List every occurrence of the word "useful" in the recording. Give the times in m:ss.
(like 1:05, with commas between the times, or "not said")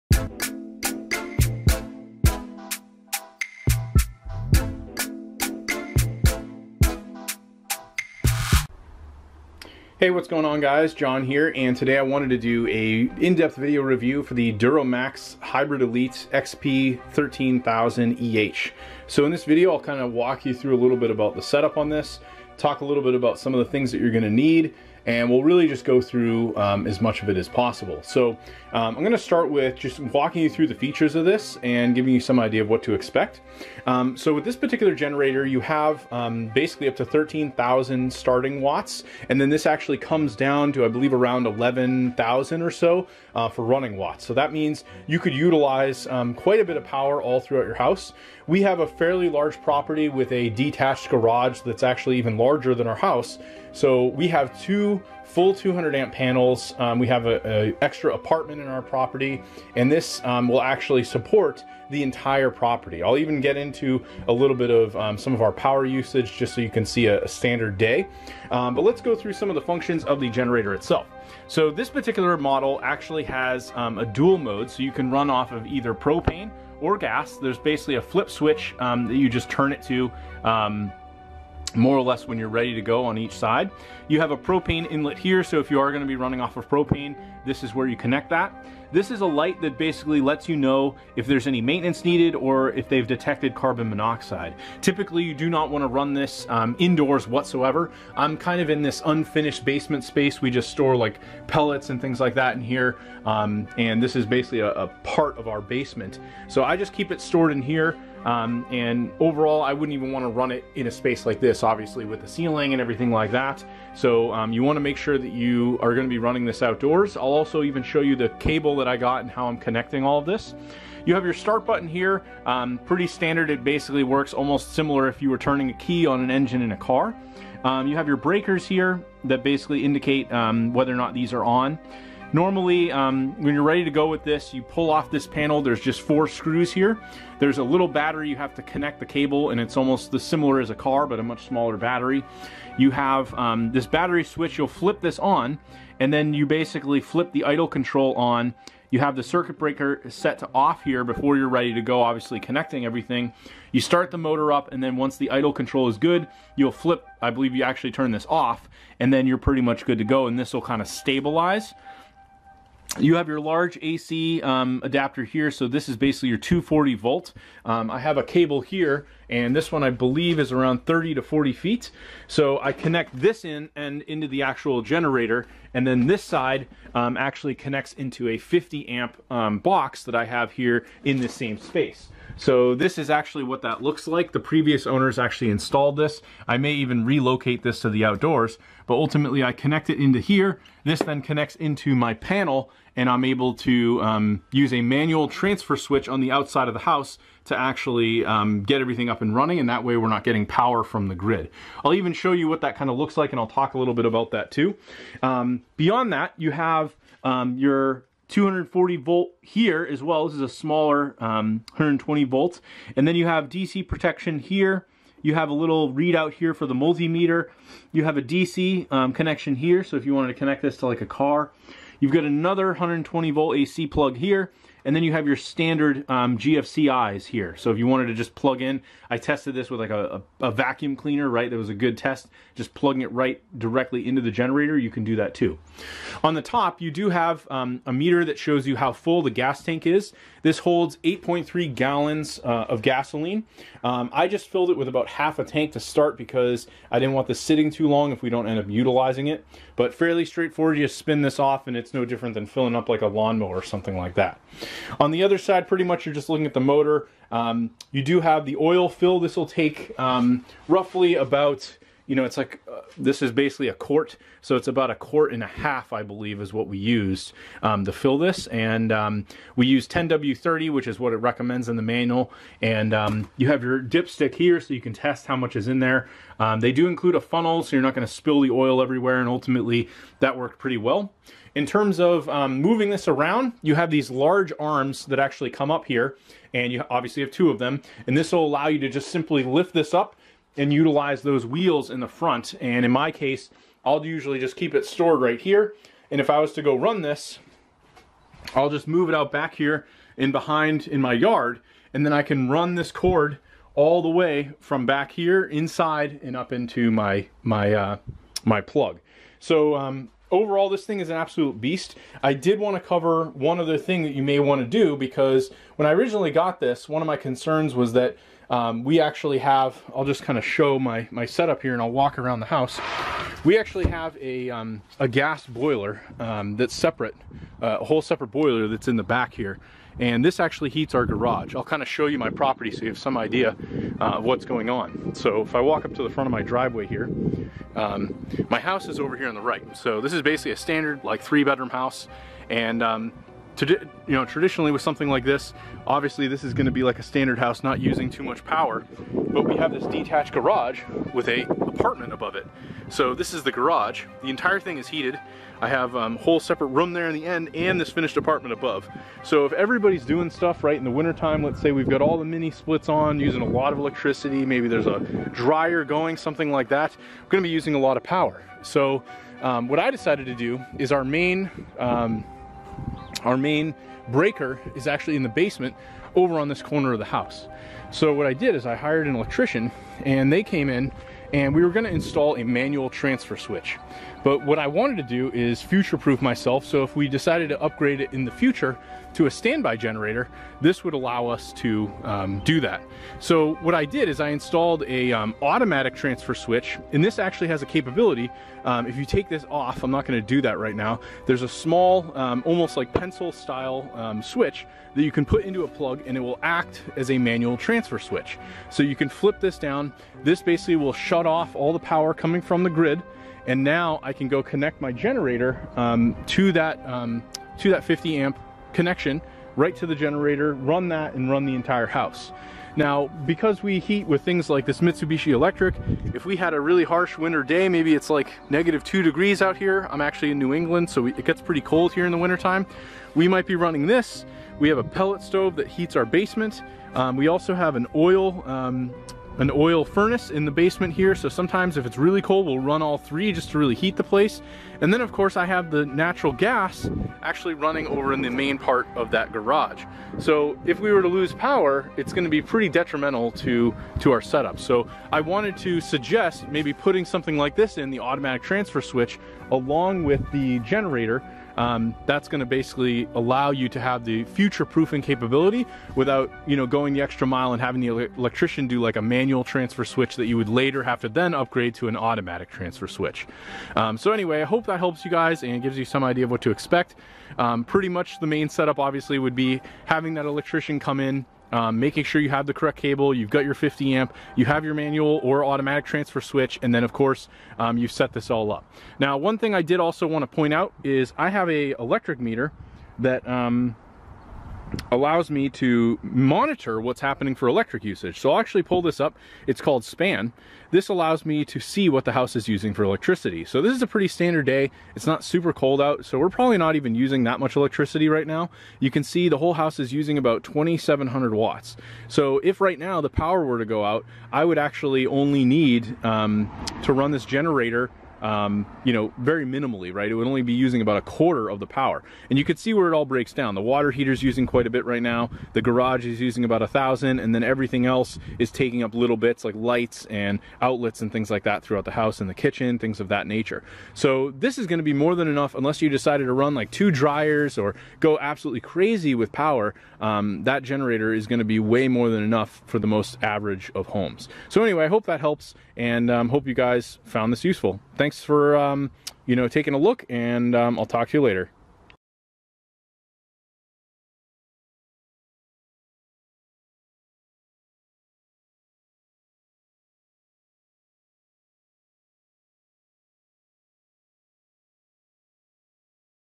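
9:07.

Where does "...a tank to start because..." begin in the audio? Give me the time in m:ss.
4:05.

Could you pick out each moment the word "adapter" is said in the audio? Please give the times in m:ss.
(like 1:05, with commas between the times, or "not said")
2:44.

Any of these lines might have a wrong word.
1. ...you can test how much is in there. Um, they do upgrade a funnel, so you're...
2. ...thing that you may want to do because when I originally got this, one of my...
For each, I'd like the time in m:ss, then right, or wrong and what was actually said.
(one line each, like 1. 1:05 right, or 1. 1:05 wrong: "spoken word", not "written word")
1. 4:34 wrong: "include", not "upgrade"
2. 5:13 right.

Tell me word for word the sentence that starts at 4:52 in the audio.
And in my case, I'll usually just keep it stored right here.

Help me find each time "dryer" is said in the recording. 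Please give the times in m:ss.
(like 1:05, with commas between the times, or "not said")
6:05, 8:56.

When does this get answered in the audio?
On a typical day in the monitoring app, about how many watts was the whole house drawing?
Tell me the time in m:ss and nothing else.
8:30.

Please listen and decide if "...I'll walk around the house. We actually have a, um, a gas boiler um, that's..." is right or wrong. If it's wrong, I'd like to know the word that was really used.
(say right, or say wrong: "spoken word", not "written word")
right.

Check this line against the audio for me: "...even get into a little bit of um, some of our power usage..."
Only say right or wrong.
right.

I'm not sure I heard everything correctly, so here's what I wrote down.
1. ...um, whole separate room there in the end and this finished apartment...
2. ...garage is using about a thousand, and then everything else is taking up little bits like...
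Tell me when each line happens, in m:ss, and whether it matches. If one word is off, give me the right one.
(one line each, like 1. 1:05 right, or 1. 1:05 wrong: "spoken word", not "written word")
1. 5:55 right
2. 8:45 right.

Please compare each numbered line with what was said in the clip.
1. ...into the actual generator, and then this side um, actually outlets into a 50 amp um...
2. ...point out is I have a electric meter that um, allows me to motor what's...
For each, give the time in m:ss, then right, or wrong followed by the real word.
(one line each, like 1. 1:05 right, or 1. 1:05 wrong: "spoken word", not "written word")
1. 2:54 wrong: "connects", not "outlets"
2. 8:10 wrong: "monitor", not "motor".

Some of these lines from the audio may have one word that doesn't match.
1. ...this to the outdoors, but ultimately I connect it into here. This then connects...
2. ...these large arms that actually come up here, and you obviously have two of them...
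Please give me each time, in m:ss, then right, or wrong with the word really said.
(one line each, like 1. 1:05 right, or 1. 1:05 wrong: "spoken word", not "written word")
1. 3:07 right
2. 4:43 right.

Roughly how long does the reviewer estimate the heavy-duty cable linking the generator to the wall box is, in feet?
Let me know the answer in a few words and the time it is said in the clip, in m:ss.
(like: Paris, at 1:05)
30 to 40 feet, at 2:50.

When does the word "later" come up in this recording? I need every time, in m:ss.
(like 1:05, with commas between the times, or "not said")
7:50, 9:11.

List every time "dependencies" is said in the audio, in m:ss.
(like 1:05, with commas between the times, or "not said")
not said.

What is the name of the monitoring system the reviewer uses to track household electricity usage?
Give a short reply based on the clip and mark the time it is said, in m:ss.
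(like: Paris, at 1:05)
SPAN, at 8:19.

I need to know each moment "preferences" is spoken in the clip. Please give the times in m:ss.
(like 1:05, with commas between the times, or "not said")
not said.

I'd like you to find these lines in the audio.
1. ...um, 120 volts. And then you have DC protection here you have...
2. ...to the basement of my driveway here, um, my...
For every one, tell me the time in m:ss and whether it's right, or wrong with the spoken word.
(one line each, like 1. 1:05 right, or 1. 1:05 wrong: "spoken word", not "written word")
1. 3:31 right
2. 5:35 wrong: "front", not "basement".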